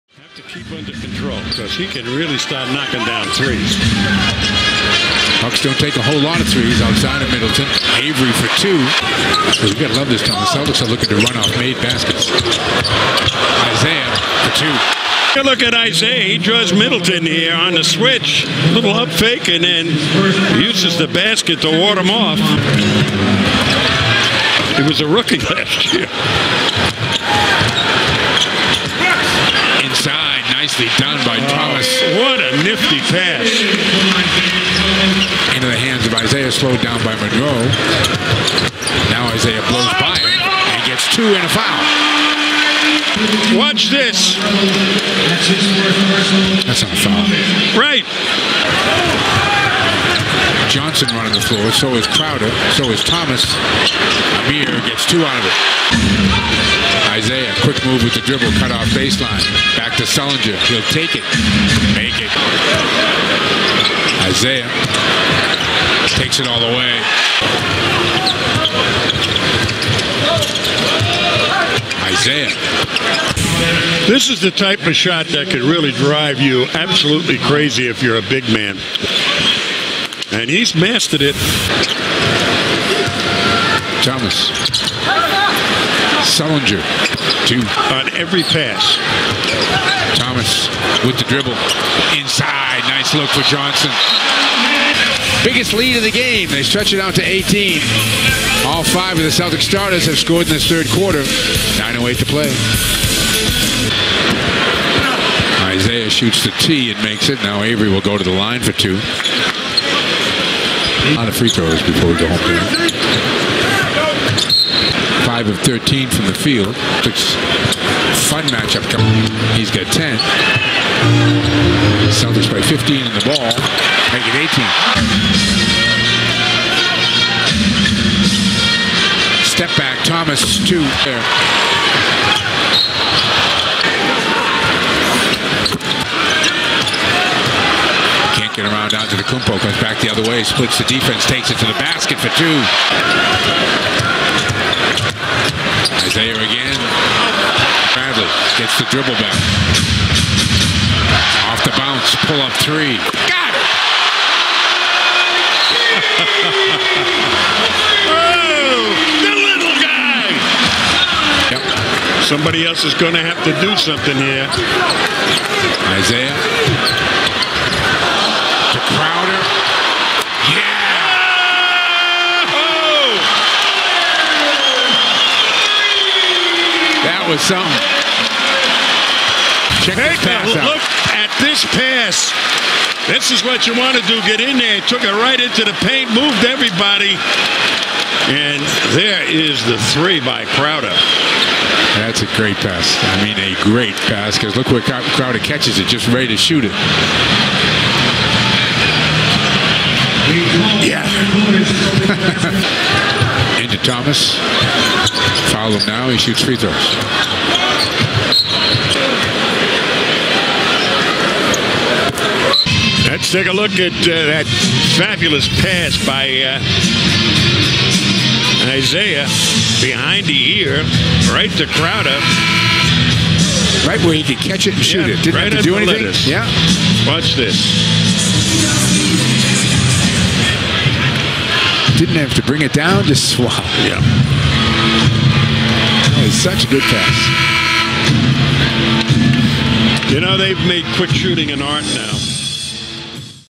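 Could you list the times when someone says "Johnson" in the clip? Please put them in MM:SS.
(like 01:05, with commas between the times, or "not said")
00:50, 01:33.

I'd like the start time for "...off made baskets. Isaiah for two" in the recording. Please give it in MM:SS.
00:11.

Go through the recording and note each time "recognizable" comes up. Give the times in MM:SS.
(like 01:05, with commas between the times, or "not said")
not said.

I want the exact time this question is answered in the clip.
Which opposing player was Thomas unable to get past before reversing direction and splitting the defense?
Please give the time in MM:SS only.
02:19.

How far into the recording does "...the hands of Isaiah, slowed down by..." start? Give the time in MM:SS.
00:35.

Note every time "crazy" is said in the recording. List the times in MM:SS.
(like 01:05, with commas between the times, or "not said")
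01:17.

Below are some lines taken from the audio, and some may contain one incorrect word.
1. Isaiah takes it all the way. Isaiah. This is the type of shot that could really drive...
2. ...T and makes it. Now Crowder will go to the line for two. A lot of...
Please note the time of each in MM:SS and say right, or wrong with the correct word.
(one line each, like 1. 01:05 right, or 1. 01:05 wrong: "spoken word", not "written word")
1. 01:04 right
2. 01:46 wrong: "Avery", not "Crowder".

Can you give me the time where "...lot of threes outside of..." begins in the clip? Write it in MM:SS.
00:06.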